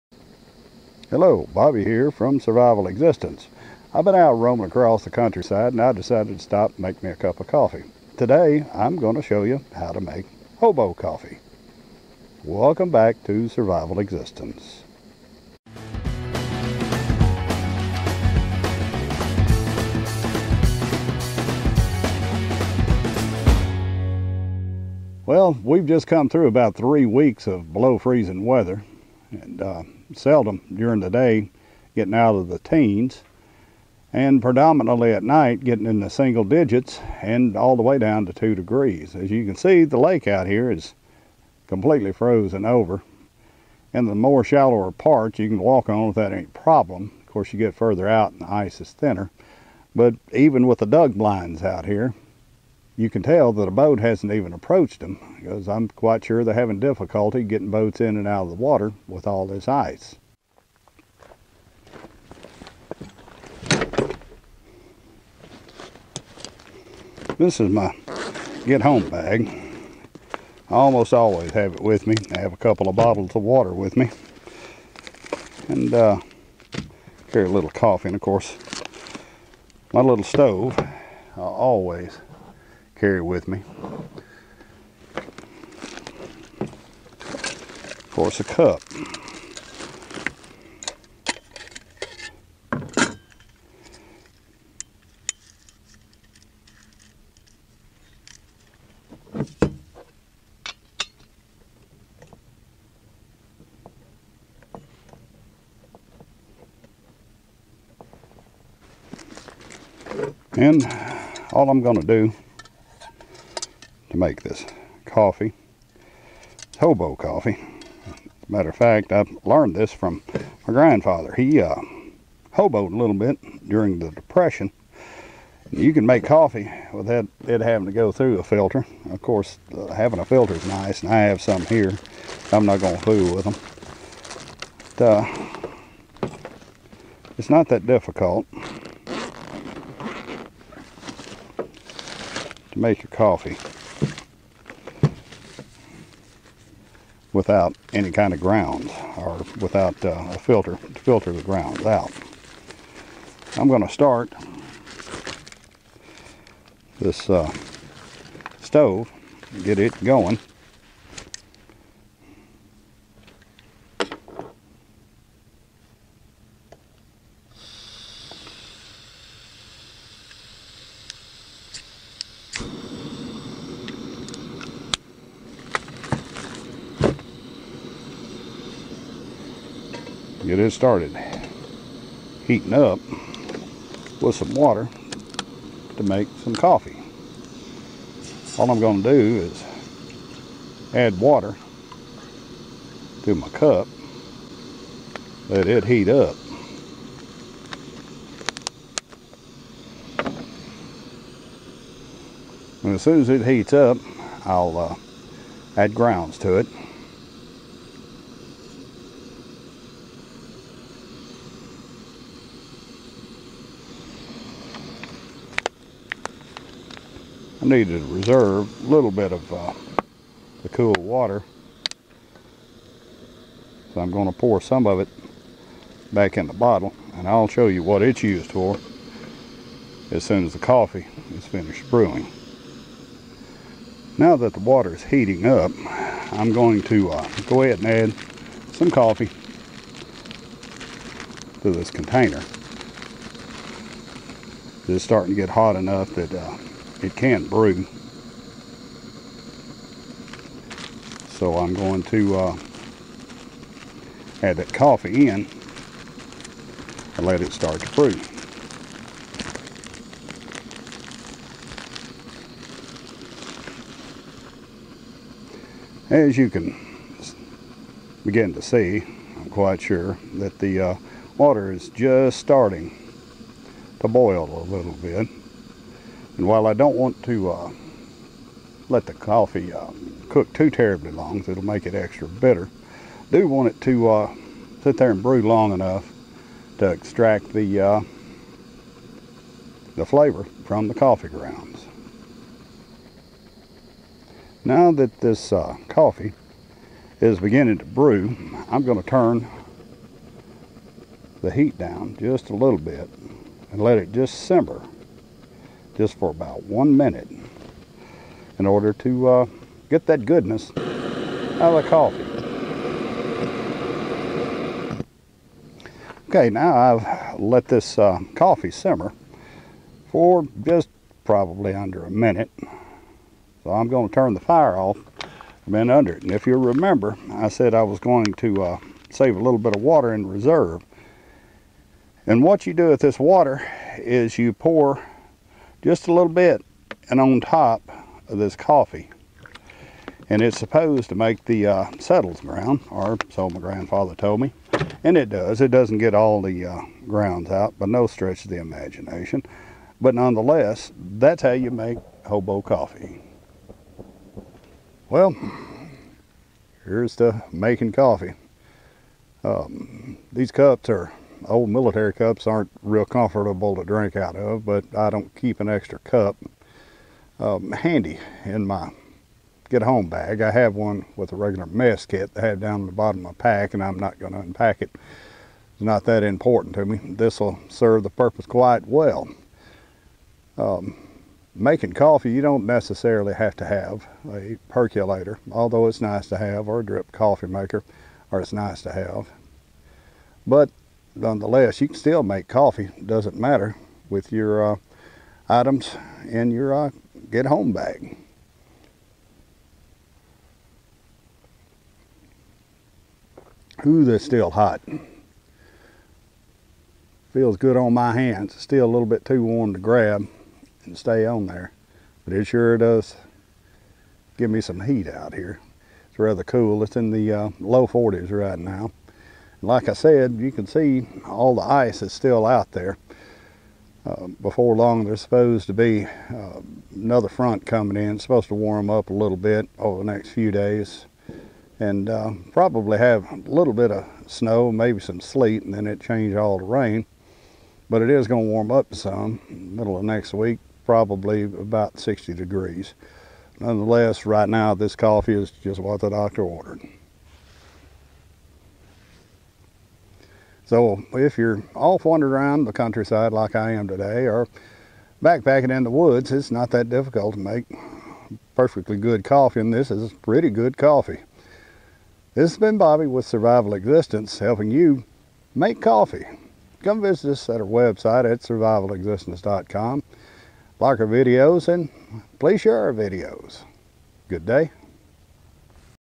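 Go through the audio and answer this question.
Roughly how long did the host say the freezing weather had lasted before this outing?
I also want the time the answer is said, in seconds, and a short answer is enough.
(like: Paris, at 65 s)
3 weeks, at 26 s.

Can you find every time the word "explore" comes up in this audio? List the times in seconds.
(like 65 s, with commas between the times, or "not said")
not said.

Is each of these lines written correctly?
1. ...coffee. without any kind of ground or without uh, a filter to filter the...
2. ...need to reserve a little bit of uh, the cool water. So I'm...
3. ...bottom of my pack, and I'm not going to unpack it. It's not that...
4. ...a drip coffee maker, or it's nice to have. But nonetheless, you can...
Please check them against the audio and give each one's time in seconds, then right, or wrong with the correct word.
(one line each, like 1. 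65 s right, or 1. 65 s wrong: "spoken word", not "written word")
1. 143 s right
2. 217 s right
3. 372 s right
4. 386 s right.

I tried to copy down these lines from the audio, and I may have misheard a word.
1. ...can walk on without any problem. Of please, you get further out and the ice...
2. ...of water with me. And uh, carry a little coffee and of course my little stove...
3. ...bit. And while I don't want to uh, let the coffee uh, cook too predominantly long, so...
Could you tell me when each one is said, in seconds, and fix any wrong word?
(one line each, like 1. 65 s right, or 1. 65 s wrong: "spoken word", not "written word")
1. 45 s wrong: "course", not "please"
2. 73 s right
3. 274 s wrong: "terribly", not "predominantly".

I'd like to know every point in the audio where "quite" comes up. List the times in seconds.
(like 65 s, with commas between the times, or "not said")
55 s, 269 s, 378 s.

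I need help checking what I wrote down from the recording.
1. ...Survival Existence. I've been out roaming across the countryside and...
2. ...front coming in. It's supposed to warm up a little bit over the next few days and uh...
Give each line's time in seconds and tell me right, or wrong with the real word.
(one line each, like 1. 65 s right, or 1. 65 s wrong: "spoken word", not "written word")
1. 2 s right
2. 427 s right.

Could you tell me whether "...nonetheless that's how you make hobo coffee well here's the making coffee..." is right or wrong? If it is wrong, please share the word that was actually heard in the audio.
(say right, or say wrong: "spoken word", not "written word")
right.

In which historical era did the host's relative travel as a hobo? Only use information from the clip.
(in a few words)
The Depression.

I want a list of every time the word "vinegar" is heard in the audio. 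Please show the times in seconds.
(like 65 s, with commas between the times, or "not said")
not said.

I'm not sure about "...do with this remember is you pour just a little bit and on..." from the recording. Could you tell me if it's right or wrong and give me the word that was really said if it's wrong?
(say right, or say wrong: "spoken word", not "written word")
wrong: "water", not "remember".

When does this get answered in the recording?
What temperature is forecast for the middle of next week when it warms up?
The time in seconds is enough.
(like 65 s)
441 s.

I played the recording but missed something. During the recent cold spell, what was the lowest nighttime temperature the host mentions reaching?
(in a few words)
2 degrees.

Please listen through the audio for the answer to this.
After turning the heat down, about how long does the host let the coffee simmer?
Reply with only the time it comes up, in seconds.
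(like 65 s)
306 s.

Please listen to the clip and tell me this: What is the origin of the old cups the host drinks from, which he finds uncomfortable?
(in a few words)
Military.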